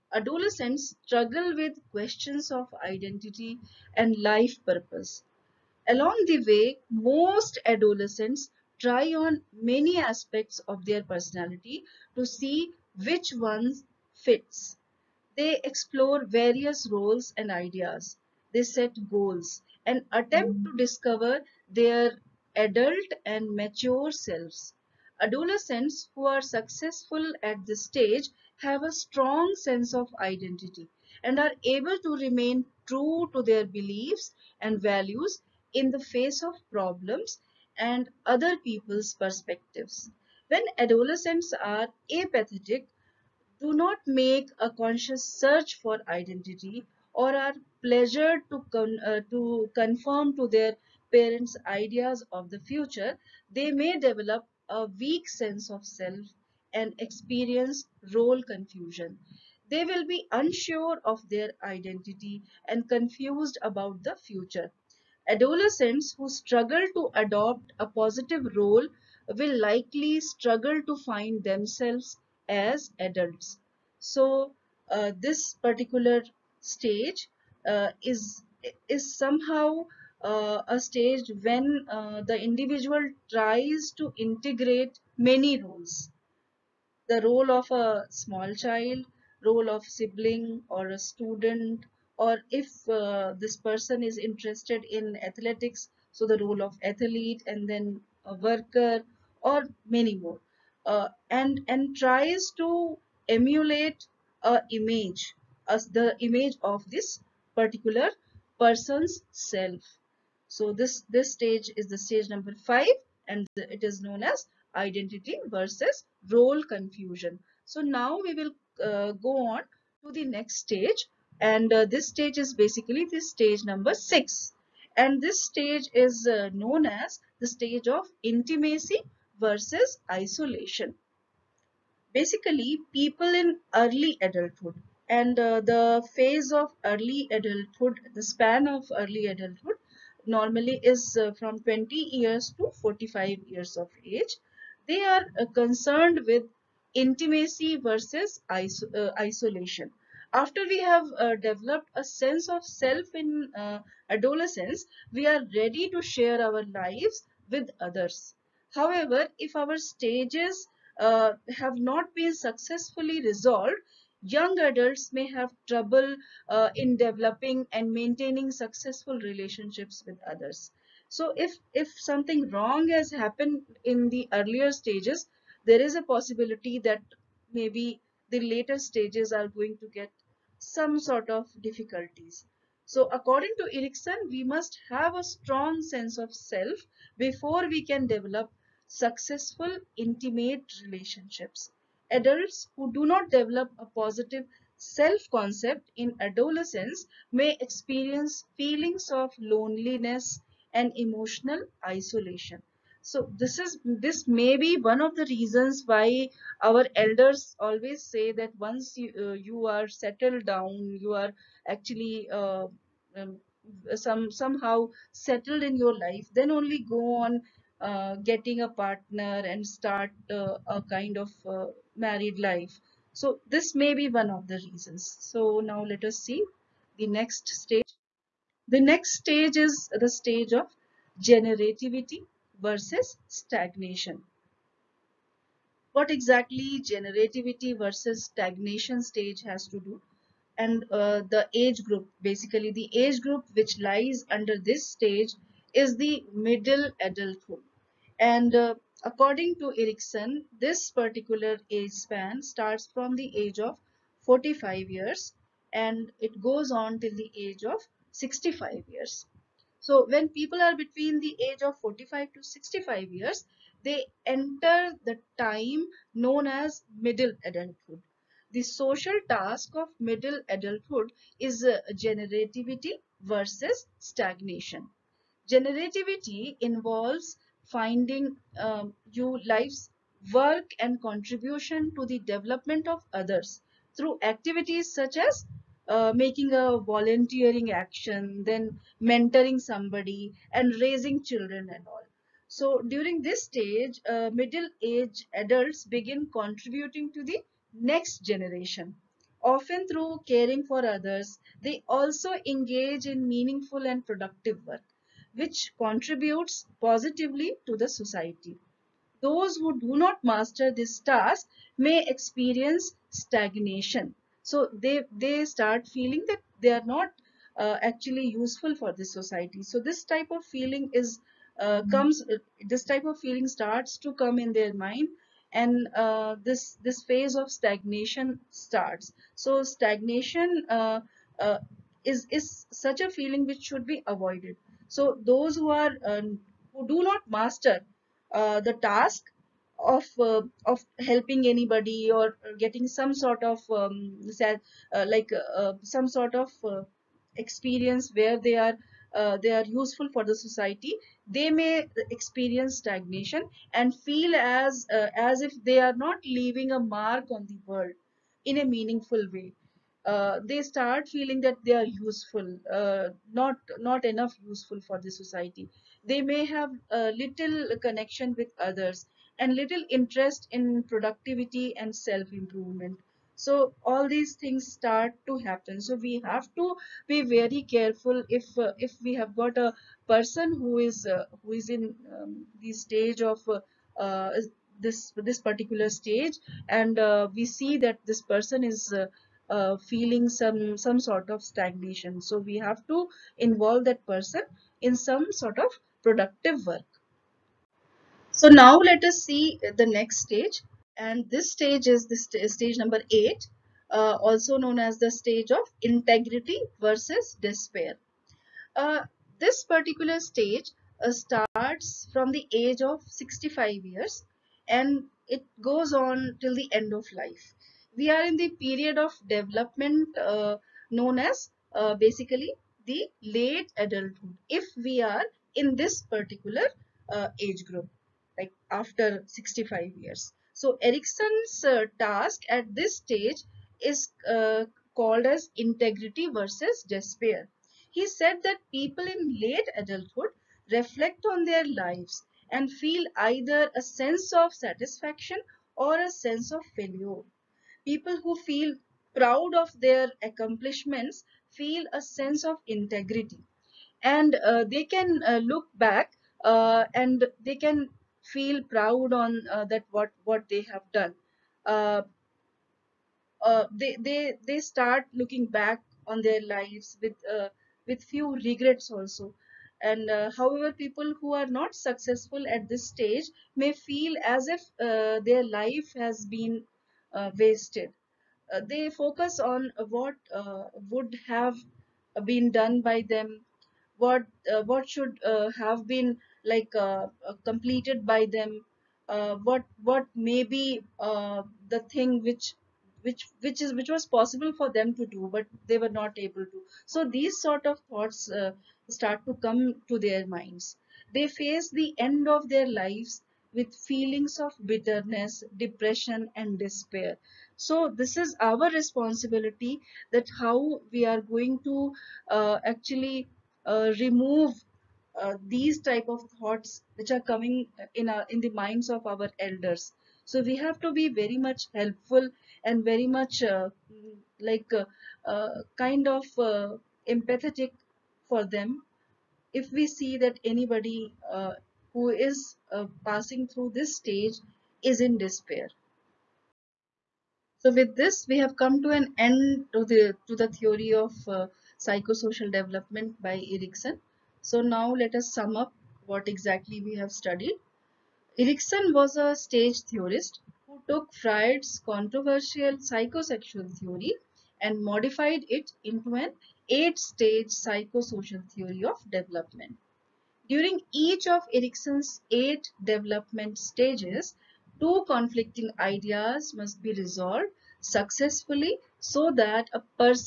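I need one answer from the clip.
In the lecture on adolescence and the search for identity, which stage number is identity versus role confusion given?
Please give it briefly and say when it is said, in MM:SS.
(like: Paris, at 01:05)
5, at 01:52.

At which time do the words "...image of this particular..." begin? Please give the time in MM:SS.
01:46.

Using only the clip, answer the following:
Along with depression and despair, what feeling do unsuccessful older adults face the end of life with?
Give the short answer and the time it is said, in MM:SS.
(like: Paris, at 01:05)
bitterness, at 08:24.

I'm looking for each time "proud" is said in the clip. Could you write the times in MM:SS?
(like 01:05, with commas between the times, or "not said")
07:29, 07:38.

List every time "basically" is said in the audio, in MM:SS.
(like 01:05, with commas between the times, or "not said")
02:02, 02:12, 04:02, 07:01.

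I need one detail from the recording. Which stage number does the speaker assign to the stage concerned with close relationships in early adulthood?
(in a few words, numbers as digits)
6.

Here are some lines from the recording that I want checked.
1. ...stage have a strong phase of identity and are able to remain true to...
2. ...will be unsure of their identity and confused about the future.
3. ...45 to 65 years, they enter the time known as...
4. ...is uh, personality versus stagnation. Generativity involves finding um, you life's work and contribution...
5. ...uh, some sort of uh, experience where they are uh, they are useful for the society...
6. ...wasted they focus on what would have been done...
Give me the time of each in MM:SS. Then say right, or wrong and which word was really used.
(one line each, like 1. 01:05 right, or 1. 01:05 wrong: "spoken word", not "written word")
1. 00:27 wrong: "sense", not "phase"
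2. 00:59 right
3. 04:21 right
4. 04:31 wrong: "generativity", not "personality"
5. 05:45 right
6. 07:57 right.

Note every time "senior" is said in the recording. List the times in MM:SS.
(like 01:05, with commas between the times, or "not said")
not said.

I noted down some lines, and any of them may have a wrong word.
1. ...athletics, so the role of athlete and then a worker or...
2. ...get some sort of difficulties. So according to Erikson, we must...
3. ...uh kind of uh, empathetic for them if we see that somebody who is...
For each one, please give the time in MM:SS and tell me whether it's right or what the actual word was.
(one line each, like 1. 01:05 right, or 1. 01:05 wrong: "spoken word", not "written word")
1. 01:35 right
2. 02:59 right
3. 08:45 wrong: "anybody", not "somebody".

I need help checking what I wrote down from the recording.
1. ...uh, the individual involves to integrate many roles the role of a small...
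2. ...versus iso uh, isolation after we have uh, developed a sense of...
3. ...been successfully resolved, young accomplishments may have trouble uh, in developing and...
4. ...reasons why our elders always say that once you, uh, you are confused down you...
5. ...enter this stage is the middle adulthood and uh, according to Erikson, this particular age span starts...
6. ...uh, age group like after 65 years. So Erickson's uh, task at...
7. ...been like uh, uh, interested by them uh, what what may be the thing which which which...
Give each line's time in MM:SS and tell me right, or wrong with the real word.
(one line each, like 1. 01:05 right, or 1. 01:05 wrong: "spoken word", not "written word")
1. 01:21 wrong: "tries", not "involves"
2. 02:27 right
3. 02:42 wrong: "adults", not "accomplishments"
4. 03:25 wrong: "settled", not "confused"
5. 04:04 wrong: "under", not "enter"
6. 07:07 right
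7. 08:05 wrong: "completed", not "interested".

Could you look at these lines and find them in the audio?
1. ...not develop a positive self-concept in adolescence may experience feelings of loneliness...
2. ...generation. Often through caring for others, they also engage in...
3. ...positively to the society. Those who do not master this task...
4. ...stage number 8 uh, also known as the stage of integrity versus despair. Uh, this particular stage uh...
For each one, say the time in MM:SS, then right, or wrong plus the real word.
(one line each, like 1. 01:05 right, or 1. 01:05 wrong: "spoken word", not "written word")
1. 03:13 right
2. 04:58 right
3. 05:06 right
4. 06:42 right.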